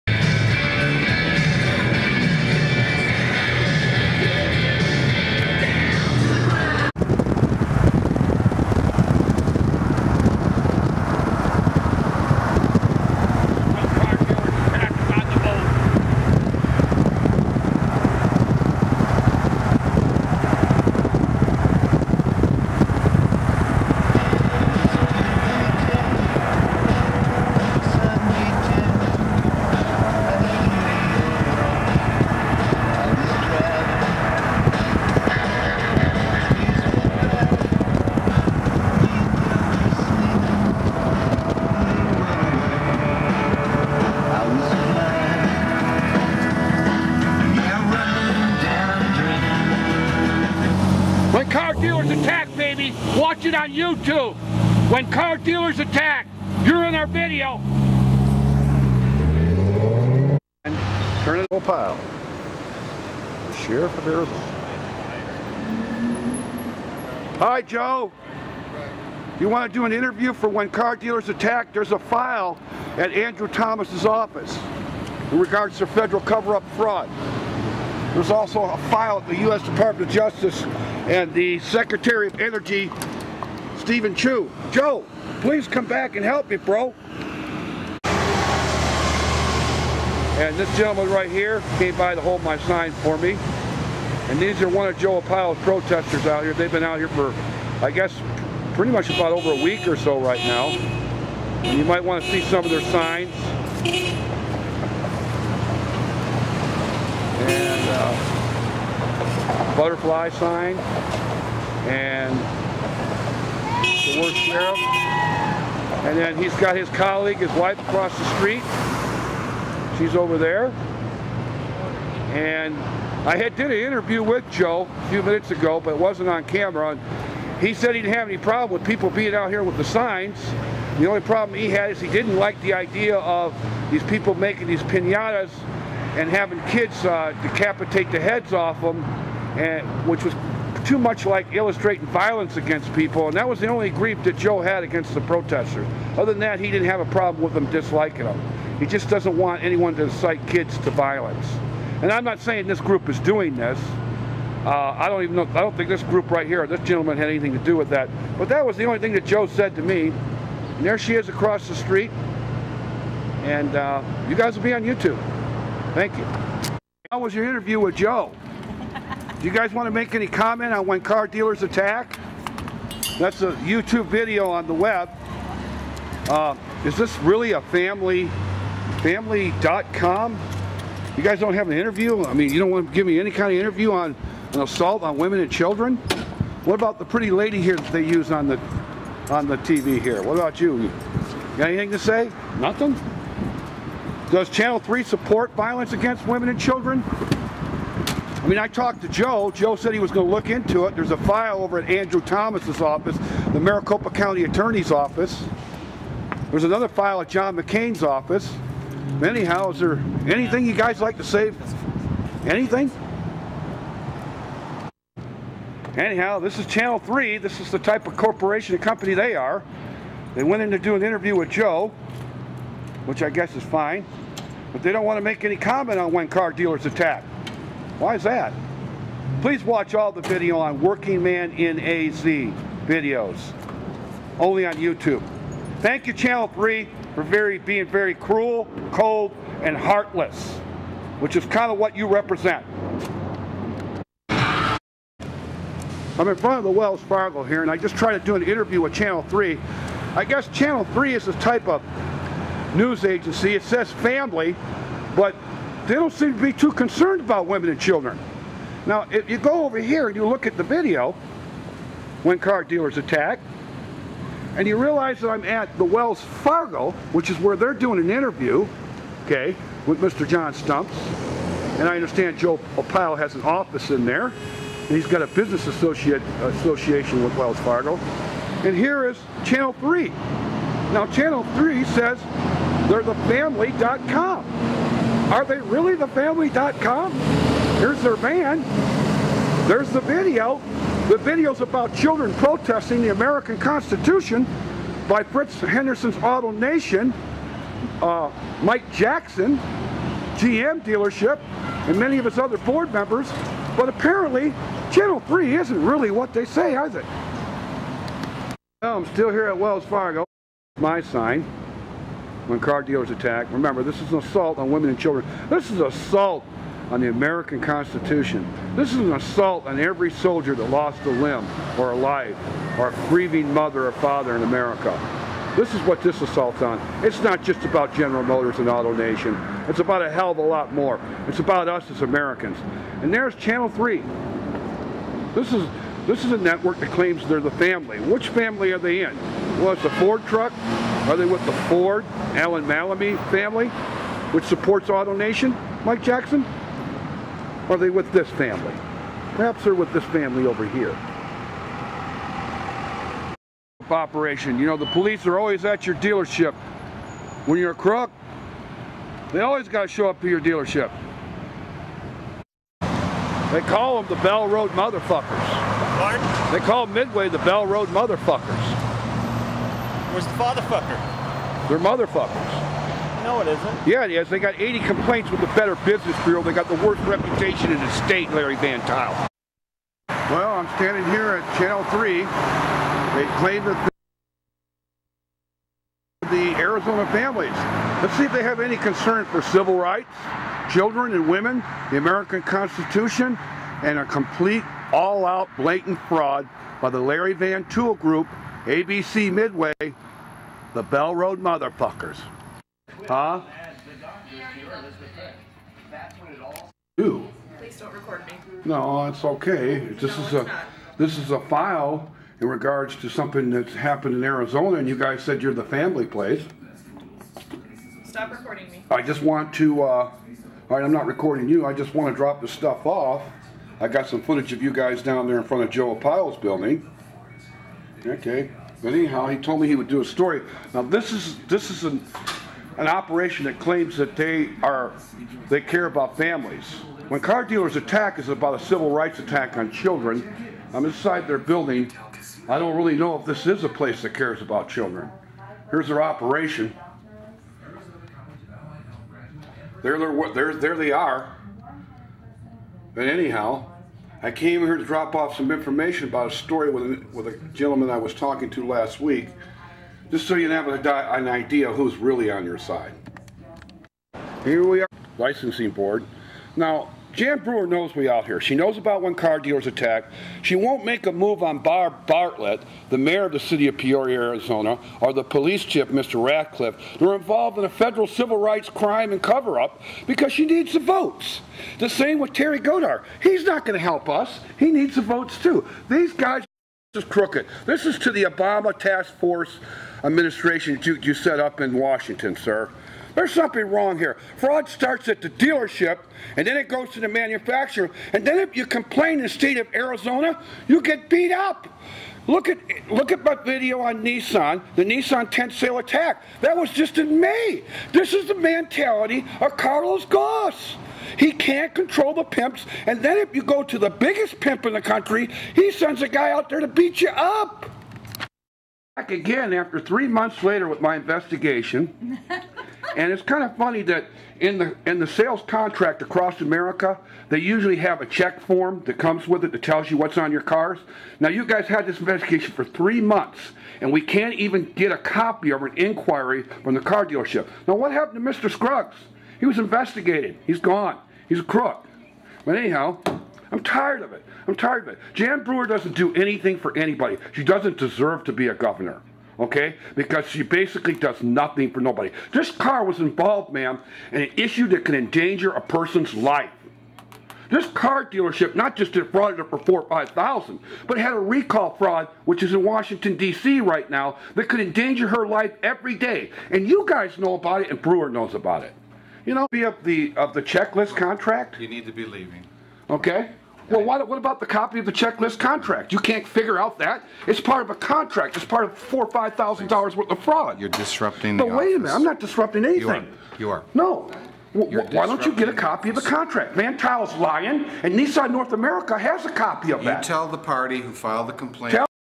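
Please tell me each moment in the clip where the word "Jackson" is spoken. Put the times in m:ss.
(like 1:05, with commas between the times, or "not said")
4:58, 5:46.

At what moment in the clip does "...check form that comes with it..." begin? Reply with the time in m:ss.
8:48.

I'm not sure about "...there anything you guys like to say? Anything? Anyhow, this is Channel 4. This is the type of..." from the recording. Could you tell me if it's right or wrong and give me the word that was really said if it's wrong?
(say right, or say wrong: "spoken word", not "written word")
wrong: "3", not "4".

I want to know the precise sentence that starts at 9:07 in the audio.
She doesn't deserve to be a governor okay?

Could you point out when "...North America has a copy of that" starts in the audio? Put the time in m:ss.
9:48.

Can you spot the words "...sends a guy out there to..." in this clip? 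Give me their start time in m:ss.
8:35.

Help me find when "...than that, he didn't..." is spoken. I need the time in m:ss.
2:26.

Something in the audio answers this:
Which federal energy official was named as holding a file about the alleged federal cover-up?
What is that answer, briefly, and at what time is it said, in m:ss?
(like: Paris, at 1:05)
Steven Chu, at 1:23.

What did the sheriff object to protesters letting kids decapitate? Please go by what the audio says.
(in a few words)
Pinatas.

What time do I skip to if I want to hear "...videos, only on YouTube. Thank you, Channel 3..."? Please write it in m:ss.
3:52.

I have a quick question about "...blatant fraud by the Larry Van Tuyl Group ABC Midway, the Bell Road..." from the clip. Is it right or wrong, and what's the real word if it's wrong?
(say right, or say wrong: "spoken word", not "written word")
right.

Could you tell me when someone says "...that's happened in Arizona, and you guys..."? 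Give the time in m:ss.
6:53.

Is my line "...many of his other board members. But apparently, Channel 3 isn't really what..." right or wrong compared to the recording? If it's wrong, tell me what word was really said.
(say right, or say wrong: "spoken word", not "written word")
right.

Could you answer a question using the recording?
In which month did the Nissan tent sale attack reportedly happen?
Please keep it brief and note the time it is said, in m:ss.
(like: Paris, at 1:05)
May, at 8:27.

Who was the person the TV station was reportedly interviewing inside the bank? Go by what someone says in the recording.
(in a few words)
John Stumpf.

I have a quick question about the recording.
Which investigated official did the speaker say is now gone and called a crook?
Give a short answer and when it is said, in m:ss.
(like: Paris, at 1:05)
Mr. Scruggs, at 8:58.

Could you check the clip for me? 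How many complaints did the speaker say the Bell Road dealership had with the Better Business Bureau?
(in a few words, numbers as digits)
80.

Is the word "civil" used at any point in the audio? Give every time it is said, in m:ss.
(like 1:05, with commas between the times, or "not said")
6:29, 7:18, 7:58.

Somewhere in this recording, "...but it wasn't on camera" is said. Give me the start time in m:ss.
2:05.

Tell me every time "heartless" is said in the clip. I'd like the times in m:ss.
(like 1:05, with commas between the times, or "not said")
3:59.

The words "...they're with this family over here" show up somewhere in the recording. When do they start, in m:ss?
5:49.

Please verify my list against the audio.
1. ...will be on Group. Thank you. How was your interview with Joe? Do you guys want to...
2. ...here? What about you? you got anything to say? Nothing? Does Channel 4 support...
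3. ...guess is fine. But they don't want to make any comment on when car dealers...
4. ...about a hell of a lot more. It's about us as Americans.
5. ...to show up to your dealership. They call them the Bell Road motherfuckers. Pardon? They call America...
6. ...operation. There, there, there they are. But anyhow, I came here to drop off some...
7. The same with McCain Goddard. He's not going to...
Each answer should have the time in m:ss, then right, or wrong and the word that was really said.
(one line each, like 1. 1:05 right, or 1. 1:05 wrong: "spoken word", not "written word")
1. 2:44 wrong: "YouTube", not "Group"
2. 3:09 wrong: "3", not "4"
3. 3:43 right
4. 5:29 right
5. 5:59 wrong: "Midway", not "America"
6. 7:26 right
7. 8:01 wrong: "Terry", not "McCain".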